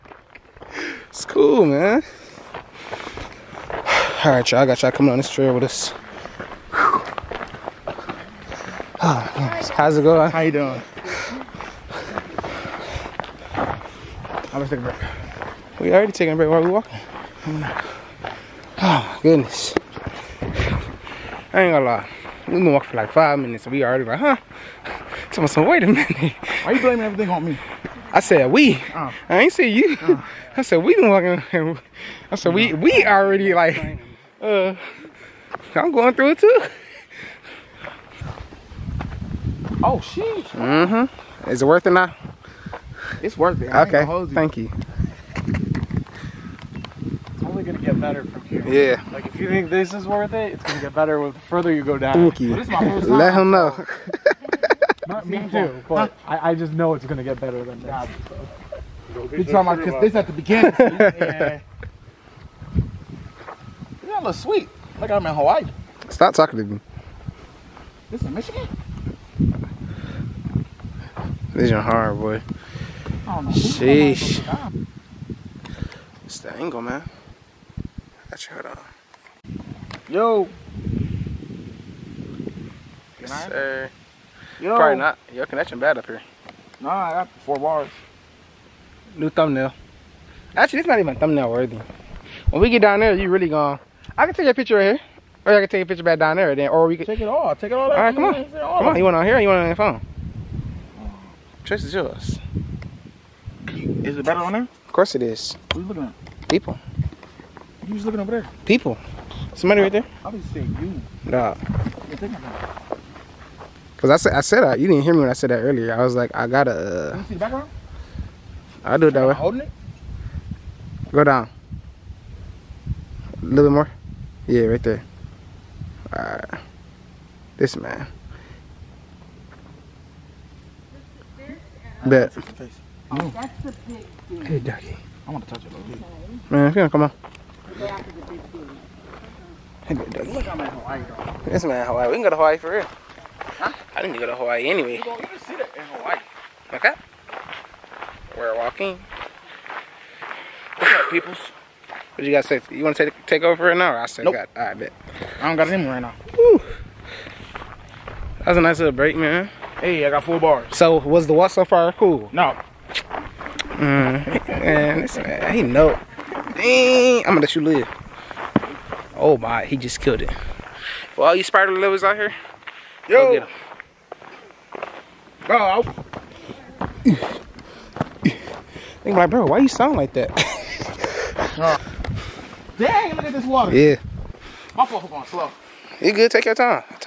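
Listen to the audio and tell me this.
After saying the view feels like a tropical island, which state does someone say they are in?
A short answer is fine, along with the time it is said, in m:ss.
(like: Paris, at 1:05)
Michigan, at 1:08.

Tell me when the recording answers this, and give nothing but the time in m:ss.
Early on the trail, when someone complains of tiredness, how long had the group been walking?
0:23.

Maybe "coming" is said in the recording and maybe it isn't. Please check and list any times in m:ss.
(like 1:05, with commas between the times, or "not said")
0:04.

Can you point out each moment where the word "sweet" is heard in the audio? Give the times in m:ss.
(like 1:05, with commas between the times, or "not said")
1:04.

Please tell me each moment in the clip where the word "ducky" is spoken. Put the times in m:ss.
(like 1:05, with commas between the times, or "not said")
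2:14, 2:19.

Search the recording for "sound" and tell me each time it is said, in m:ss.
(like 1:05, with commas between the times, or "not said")
2:59.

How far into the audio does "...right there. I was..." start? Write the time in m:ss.
1:49.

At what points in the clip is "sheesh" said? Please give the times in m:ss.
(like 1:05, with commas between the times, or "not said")
0:40, 1:13.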